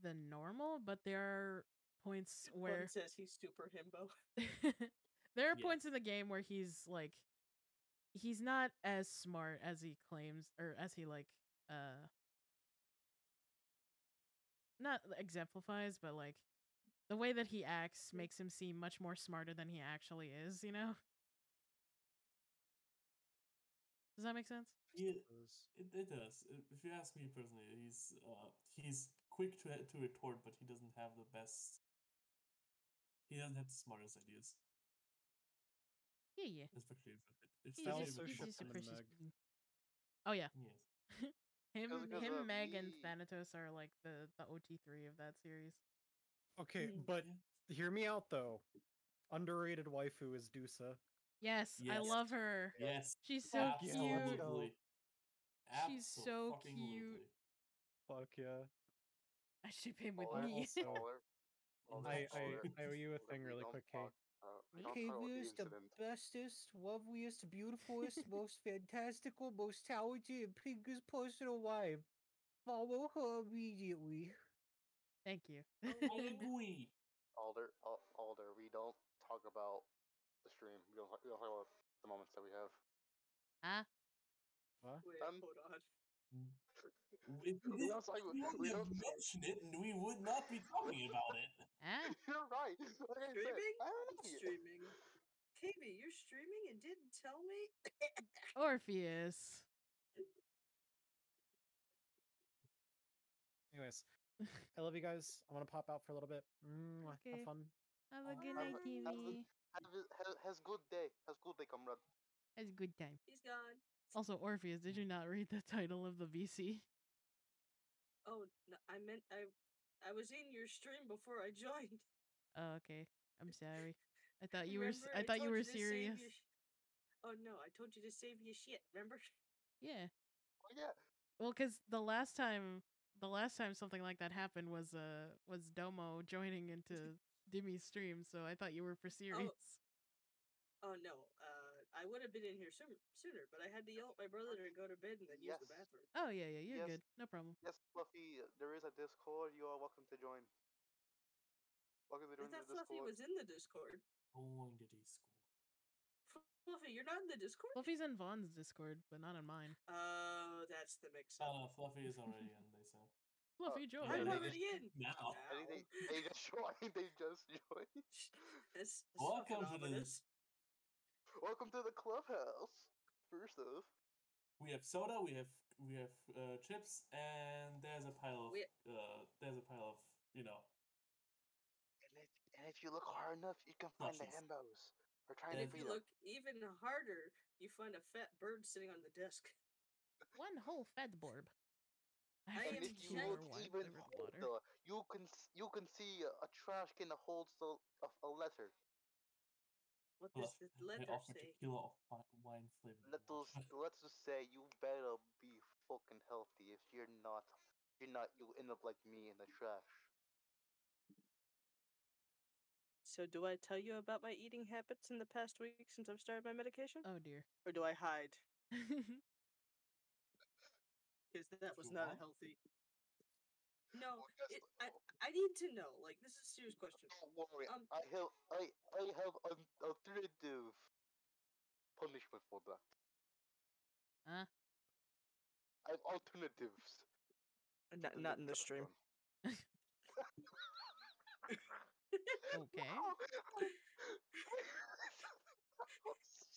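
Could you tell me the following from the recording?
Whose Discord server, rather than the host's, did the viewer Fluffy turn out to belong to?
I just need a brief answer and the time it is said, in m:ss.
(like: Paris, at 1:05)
Vaughn, at 2:38.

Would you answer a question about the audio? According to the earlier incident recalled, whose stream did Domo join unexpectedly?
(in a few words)
Demi.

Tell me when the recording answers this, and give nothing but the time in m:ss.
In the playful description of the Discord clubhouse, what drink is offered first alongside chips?
2:54.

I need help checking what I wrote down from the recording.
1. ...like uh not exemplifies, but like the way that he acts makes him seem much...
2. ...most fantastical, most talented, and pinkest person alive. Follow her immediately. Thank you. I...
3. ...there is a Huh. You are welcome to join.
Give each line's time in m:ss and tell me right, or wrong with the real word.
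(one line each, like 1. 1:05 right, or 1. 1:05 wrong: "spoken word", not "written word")
1. 0:11 right
2. 1:08 right
3. 2:28 wrong: "Discord", not "Huh".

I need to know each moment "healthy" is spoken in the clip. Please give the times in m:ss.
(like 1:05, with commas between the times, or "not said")
3:26, 3:42.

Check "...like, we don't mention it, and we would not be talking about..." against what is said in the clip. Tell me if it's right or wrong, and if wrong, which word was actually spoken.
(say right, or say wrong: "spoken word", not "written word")
right.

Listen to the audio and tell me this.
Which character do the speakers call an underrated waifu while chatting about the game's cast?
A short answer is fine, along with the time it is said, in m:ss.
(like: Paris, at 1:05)
Dusa, at 0:50.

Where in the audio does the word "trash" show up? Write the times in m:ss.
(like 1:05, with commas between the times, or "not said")
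3:16, 3:29.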